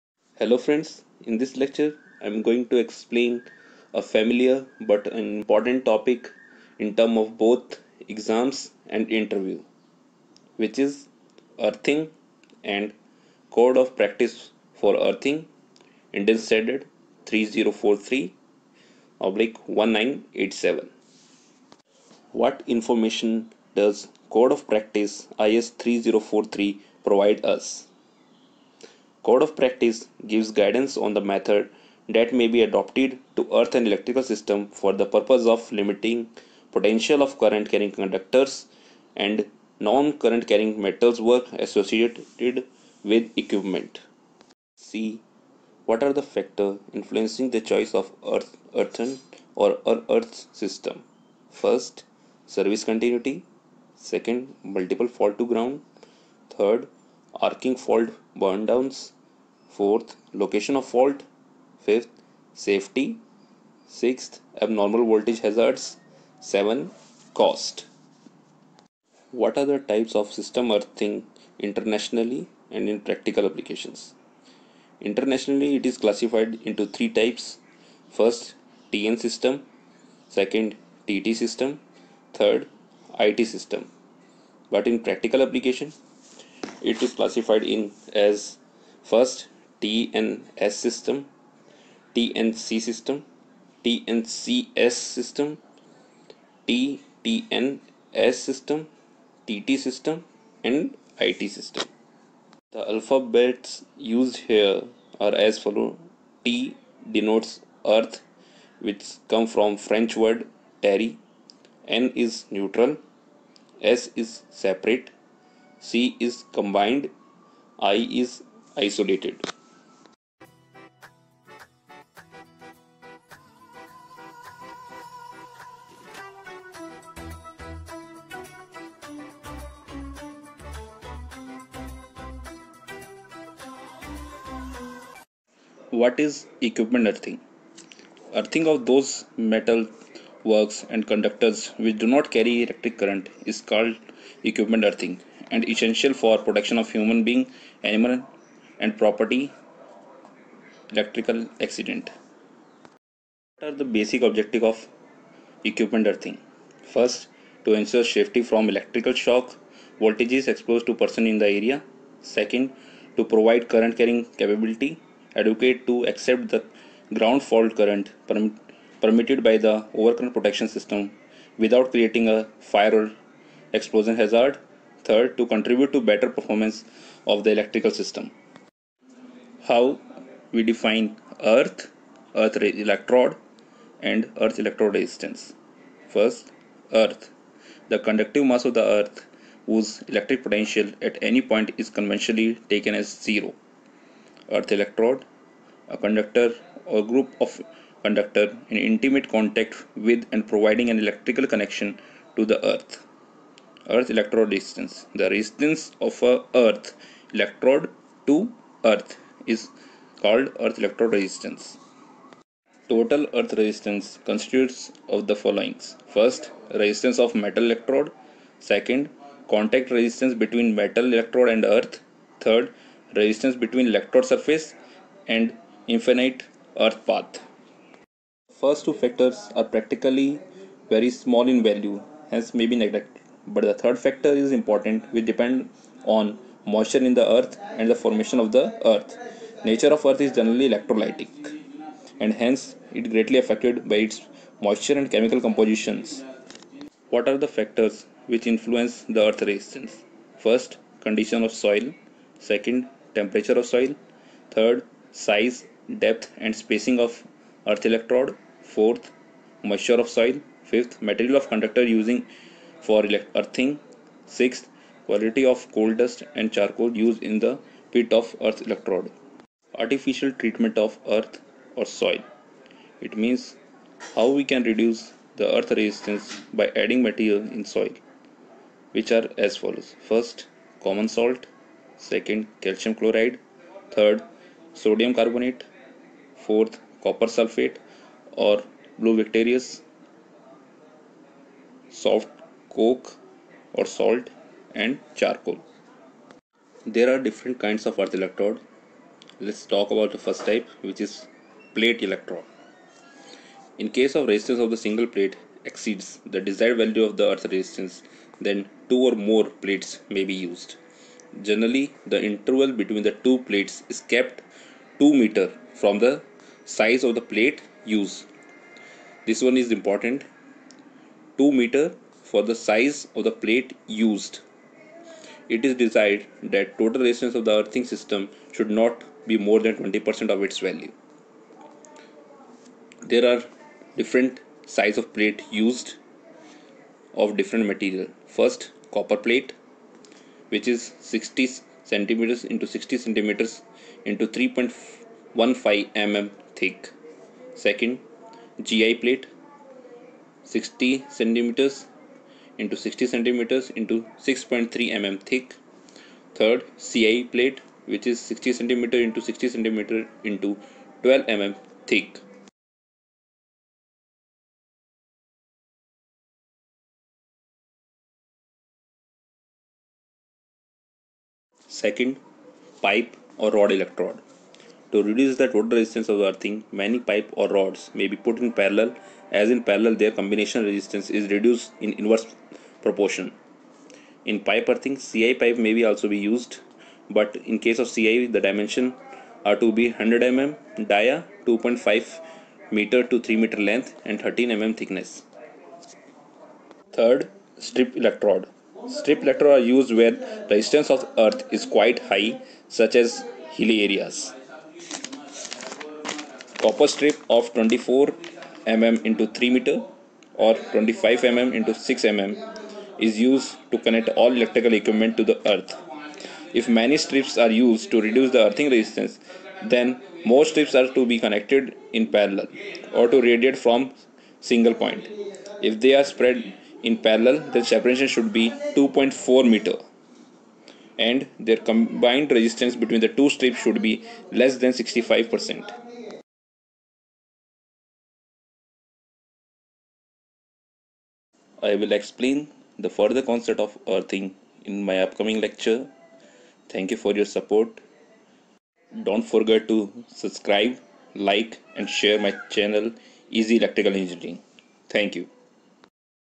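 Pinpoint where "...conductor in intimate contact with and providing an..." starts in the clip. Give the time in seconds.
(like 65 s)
198 s.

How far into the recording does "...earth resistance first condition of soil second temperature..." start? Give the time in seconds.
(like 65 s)
249 s.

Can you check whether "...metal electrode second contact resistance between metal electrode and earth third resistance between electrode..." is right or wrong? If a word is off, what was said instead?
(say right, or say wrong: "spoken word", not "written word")
right.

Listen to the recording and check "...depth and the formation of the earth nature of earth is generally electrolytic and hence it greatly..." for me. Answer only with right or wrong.
wrong.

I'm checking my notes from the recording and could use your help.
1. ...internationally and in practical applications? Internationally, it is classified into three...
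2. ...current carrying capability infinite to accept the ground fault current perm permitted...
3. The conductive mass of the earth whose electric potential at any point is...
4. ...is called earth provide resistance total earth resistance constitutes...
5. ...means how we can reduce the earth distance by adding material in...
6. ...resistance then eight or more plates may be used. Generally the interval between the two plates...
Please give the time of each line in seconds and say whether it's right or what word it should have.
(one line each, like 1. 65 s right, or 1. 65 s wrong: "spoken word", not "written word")
1. 71 s right
2. 163 s wrong: "advocate", not "infinite"
3. 187 s right
4. 209 s wrong: "electrode", not "provide"
5. 273 s wrong: "resistance", not "distance"
6. 307 s wrong: "two", not "eight".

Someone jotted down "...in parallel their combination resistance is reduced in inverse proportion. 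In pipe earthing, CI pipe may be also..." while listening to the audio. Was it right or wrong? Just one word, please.
right.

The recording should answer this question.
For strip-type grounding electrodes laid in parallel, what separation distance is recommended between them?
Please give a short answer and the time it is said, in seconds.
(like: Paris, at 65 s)
2.4 meters, at 428 s.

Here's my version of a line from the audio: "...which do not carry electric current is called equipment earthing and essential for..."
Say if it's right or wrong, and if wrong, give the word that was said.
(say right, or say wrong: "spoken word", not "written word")
right.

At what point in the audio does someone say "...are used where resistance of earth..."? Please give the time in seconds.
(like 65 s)
399 s.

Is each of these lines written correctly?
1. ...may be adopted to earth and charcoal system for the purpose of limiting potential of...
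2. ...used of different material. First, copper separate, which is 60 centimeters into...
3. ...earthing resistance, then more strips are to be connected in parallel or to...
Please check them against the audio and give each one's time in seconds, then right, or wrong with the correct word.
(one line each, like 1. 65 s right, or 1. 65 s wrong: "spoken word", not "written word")
1. 32 s wrong: "electrical", not "charcoal"
2. 335 s wrong: "plate", not "separate"
3. 418 s right.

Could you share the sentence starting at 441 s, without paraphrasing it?
I will explain the further concept of earthing in my upcoming lecture.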